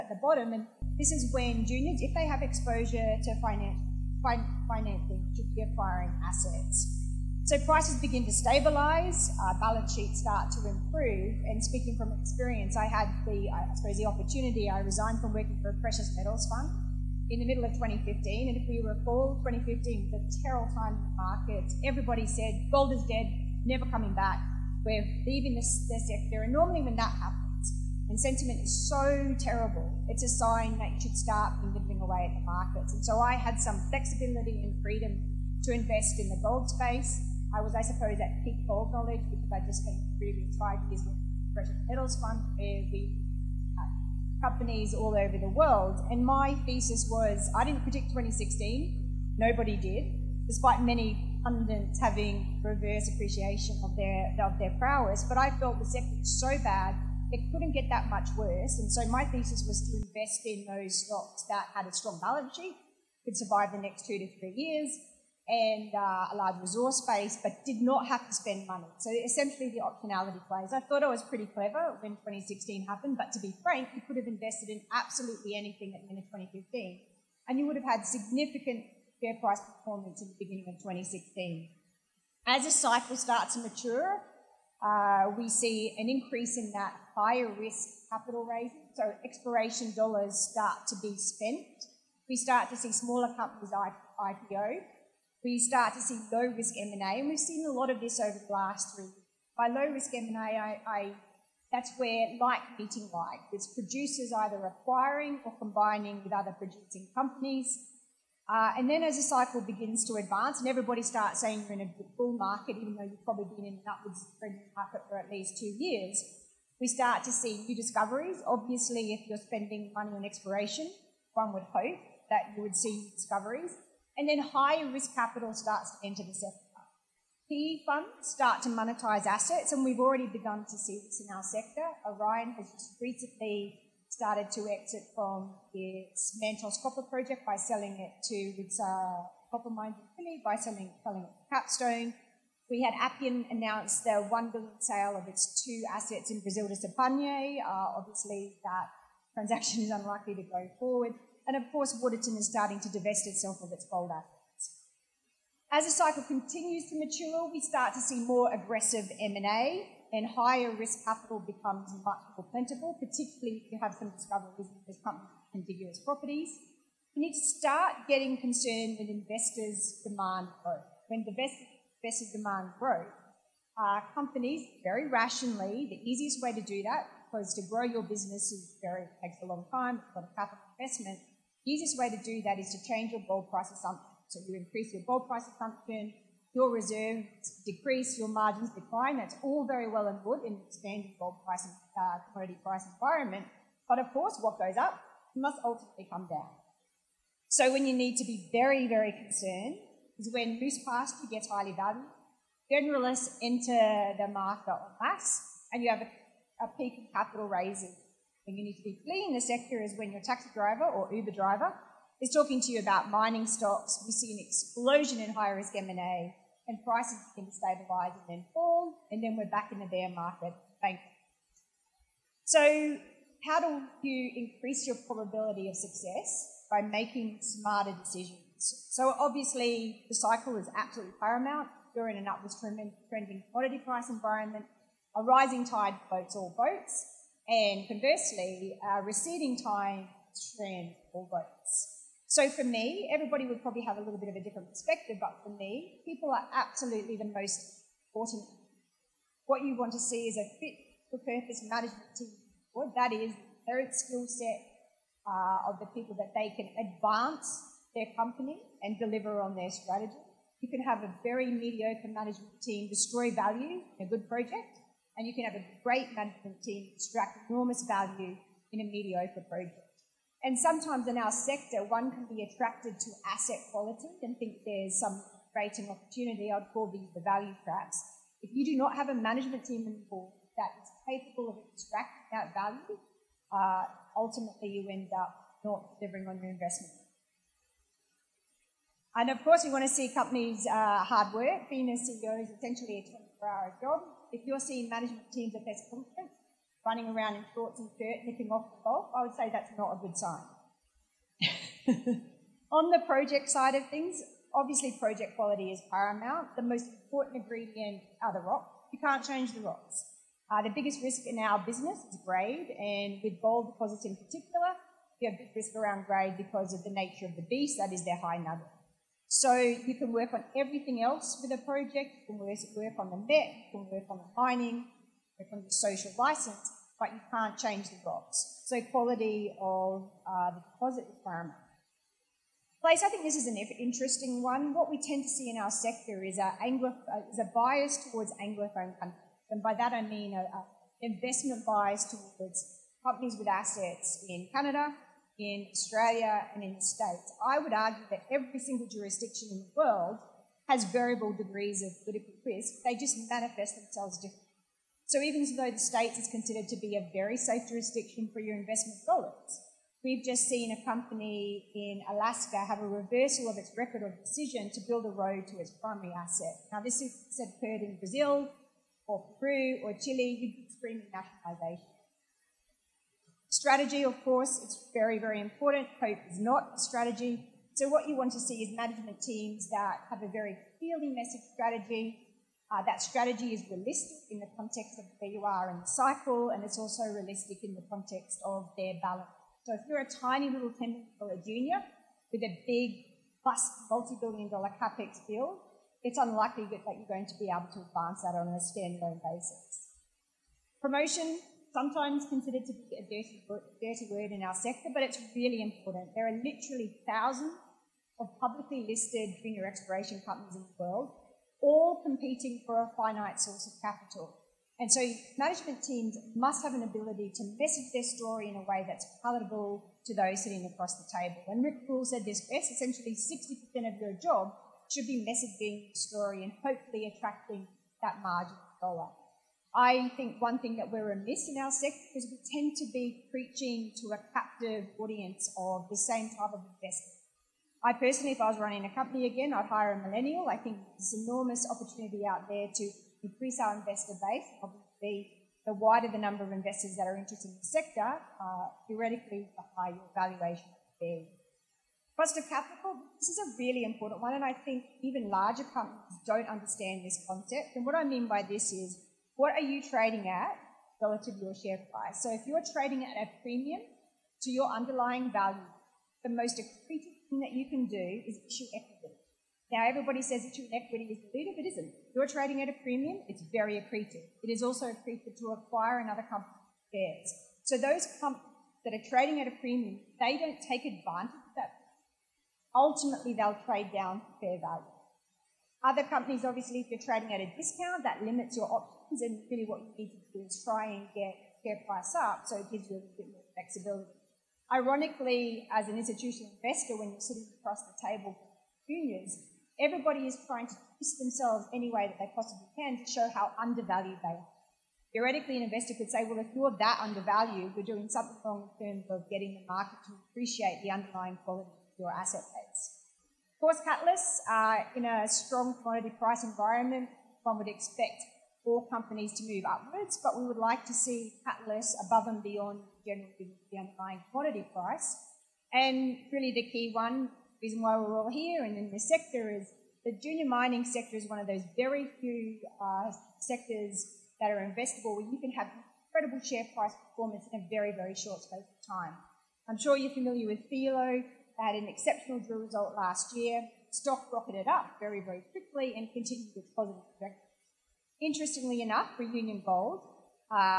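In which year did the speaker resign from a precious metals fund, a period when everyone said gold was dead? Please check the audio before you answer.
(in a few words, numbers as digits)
2015.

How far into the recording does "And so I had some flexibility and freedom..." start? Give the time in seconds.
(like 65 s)
32 s.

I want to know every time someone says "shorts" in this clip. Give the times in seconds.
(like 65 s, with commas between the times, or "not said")
297 s, 538 s.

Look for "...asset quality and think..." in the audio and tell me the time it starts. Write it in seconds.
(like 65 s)
273 s.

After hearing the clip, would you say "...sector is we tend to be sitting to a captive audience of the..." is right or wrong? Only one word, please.
wrong.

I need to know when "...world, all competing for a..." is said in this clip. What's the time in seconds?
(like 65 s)
410 s.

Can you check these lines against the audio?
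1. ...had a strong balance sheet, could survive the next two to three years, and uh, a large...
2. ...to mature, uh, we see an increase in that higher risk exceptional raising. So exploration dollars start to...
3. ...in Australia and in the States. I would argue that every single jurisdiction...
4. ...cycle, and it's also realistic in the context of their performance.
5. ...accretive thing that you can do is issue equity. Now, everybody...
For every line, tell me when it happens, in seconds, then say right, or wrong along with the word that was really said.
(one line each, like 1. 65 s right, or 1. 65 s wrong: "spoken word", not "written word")
1. 61 s right
2. 83 s wrong: "capital", not "exceptional"
3. 345 s right
4. 385 s wrong: "balance", not "performance"
5. 466 s right.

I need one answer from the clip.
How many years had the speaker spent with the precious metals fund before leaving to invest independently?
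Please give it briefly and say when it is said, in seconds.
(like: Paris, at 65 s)
5, at 40 s.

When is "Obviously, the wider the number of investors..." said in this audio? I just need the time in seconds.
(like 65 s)
444 s.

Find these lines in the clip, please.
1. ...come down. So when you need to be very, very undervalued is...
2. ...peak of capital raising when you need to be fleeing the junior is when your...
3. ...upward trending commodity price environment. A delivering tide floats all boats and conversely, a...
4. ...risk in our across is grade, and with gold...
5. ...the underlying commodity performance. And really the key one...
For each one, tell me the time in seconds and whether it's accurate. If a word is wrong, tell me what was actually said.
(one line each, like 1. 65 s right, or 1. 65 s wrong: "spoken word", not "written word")
1. 196 s wrong: "concerned", not "undervalued"
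2. 206 s wrong: "sector", not "junior"
3. 232 s wrong: "rising", not "delivering"
4. 311 s wrong: "business", not "across"
5. 523 s wrong: "price", not "performance".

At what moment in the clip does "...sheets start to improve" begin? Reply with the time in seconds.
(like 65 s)
9 s.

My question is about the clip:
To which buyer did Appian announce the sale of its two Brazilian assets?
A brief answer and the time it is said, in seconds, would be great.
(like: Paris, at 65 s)
Sibanye, at 146 s.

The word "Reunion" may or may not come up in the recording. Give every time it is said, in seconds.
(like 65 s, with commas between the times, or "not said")
549 s.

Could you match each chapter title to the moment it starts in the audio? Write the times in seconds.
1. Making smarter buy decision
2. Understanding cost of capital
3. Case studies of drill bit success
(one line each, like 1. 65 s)
1. 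220 s
2. 453 s
3. 529 s.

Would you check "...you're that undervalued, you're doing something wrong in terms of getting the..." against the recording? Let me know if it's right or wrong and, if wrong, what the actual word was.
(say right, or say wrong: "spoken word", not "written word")
right.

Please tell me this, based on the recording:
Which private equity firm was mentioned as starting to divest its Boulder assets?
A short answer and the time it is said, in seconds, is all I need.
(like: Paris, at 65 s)
Waterton, at 151 s.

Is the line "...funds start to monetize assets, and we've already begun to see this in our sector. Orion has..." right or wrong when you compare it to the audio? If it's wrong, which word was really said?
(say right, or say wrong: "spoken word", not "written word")
right.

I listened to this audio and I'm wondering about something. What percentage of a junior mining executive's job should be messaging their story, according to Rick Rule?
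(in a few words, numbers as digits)
60%.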